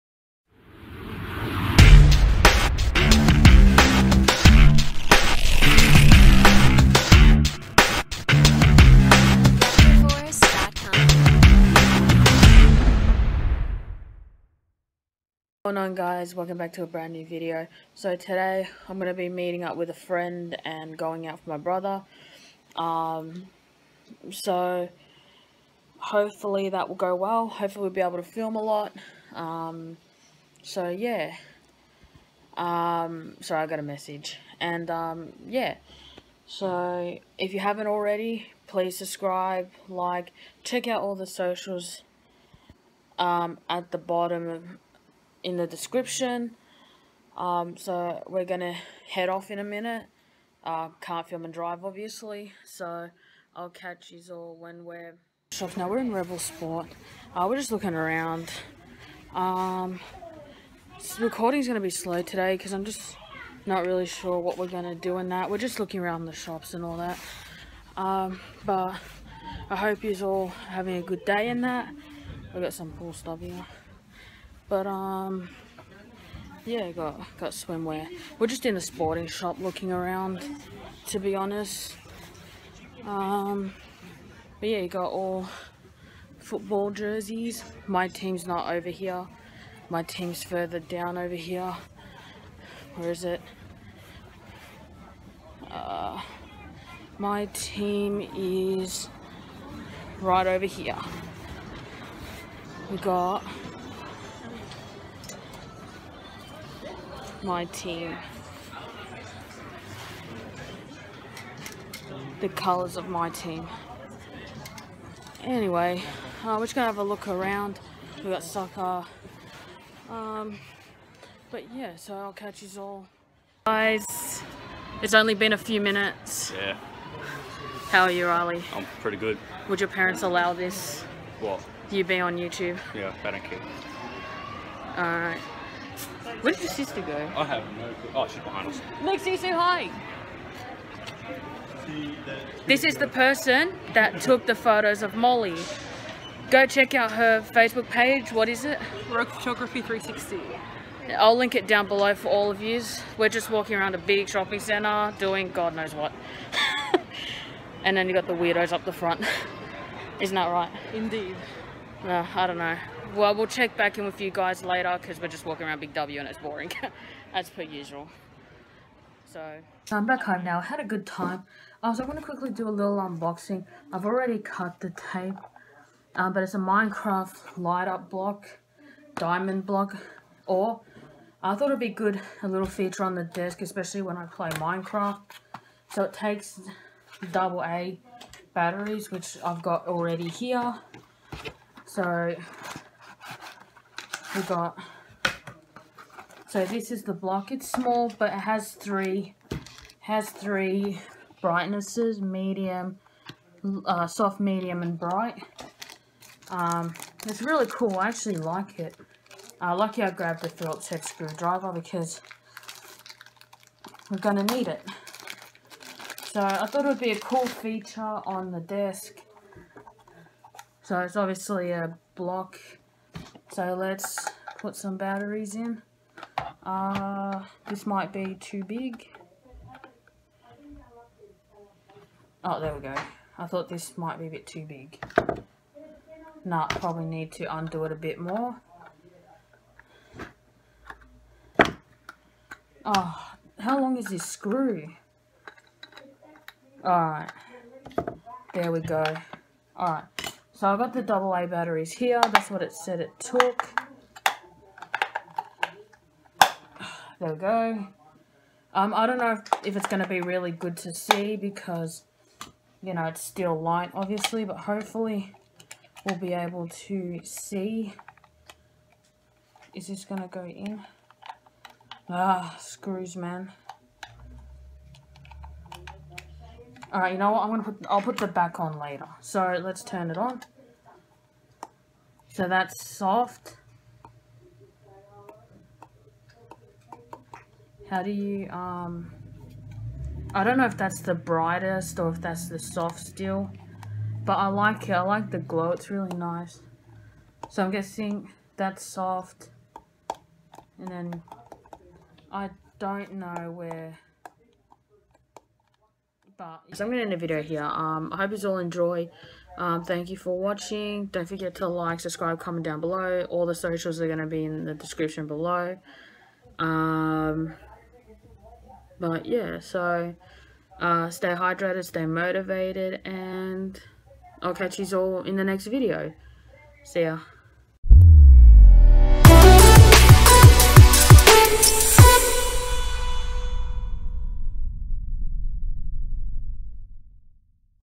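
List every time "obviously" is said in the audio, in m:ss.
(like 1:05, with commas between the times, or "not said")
0:51, 3:41, 4:23.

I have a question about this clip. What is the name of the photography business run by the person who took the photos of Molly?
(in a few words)
Rogue Photography 360.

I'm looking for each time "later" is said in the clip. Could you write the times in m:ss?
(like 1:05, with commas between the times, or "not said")
2:44, 4:38.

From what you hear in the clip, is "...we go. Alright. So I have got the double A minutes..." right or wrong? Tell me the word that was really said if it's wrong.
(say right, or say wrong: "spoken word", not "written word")
wrong: "batteries", not "minutes".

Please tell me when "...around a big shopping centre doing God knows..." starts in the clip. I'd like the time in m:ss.
2:33.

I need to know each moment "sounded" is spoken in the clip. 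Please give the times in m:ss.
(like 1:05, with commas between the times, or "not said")
not said.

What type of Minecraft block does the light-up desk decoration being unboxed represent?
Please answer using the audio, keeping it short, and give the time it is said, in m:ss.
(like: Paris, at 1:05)
Diamond block, at 2:59.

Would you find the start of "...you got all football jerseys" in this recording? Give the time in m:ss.
1:24.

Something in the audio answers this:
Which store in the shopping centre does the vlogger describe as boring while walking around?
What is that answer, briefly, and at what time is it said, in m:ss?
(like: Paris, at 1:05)
Big W, at 2:45.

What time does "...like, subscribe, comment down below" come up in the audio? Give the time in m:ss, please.
5:11.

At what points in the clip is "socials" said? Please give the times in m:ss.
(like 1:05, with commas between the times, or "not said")
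0:41, 5:13.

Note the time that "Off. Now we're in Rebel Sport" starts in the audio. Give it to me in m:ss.
0:55.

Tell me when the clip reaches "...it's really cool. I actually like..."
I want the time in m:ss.
3:27.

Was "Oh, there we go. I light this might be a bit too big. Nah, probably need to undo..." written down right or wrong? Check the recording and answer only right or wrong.
wrong.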